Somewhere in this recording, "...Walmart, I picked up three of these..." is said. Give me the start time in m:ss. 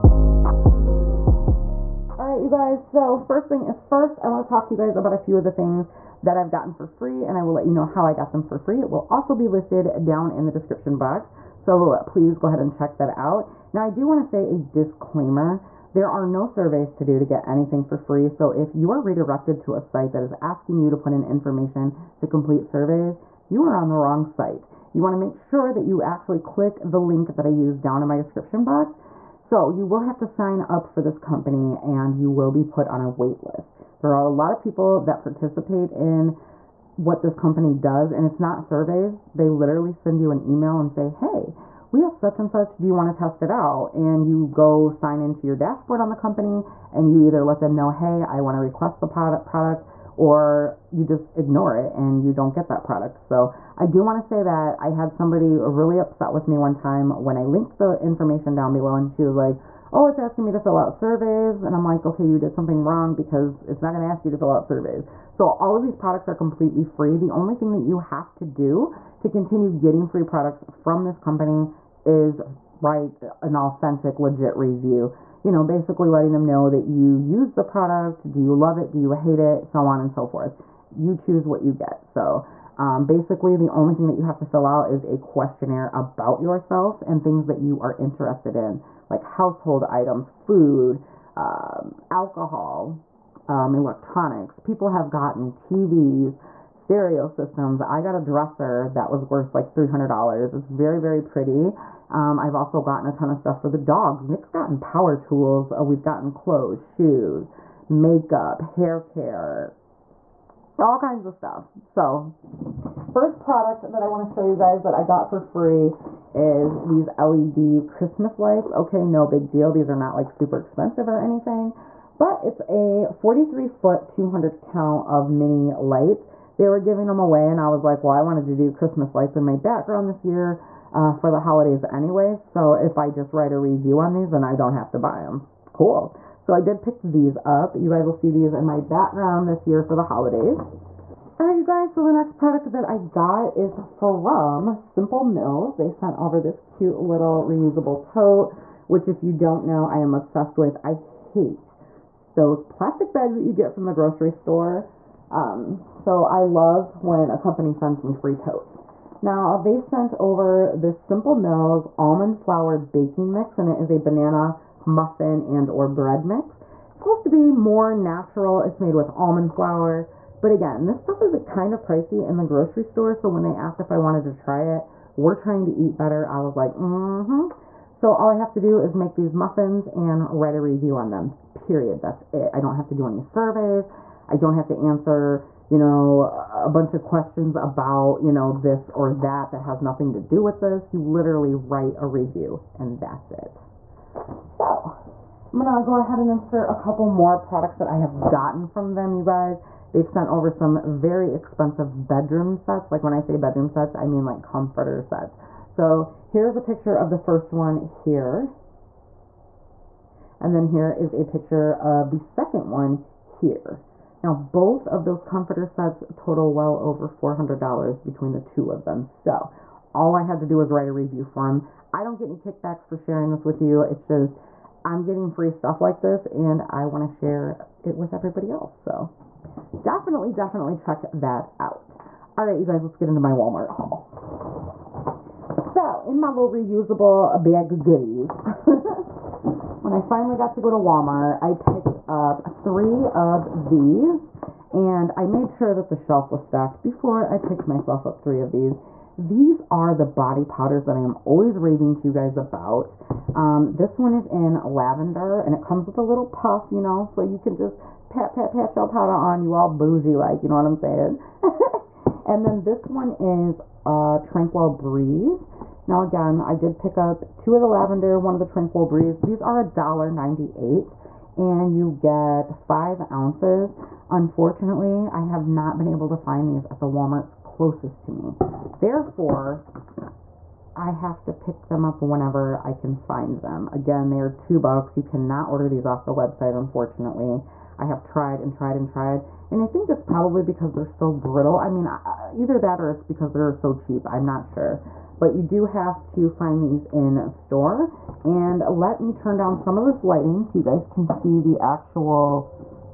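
4:00.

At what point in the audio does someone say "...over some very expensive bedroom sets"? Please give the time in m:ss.
3:20.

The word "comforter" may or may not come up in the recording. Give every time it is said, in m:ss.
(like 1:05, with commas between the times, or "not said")
3:24, 3:35.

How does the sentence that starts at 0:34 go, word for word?
There are a lot of people that participate in what this company does and it's not surveys.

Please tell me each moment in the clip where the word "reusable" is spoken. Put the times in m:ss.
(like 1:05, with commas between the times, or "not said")
2:27, 3:56.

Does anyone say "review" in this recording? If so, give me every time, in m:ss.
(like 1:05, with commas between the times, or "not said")
1:14, 2:13, 3:00, 3:12, 3:40.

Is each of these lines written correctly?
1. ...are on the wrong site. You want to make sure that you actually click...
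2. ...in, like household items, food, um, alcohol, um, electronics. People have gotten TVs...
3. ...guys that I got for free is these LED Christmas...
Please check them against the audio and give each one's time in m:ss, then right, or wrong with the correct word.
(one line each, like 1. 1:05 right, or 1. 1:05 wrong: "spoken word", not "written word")
1. 0:23 right
2. 1:28 right
3. 1:54 right.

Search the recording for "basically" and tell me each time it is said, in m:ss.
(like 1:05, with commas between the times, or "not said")
1:15, 1:23.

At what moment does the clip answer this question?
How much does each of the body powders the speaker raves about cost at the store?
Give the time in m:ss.
4:29.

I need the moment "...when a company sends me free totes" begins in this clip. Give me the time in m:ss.
2:37.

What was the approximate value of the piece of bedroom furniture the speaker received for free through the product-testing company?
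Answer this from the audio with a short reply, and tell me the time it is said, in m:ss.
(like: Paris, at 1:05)
$300, at 1:39.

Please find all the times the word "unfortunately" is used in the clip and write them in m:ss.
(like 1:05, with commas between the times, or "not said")
4:34, 4:46.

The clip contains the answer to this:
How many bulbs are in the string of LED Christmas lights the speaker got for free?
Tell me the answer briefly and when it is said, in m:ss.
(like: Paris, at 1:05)
200, at 2:04.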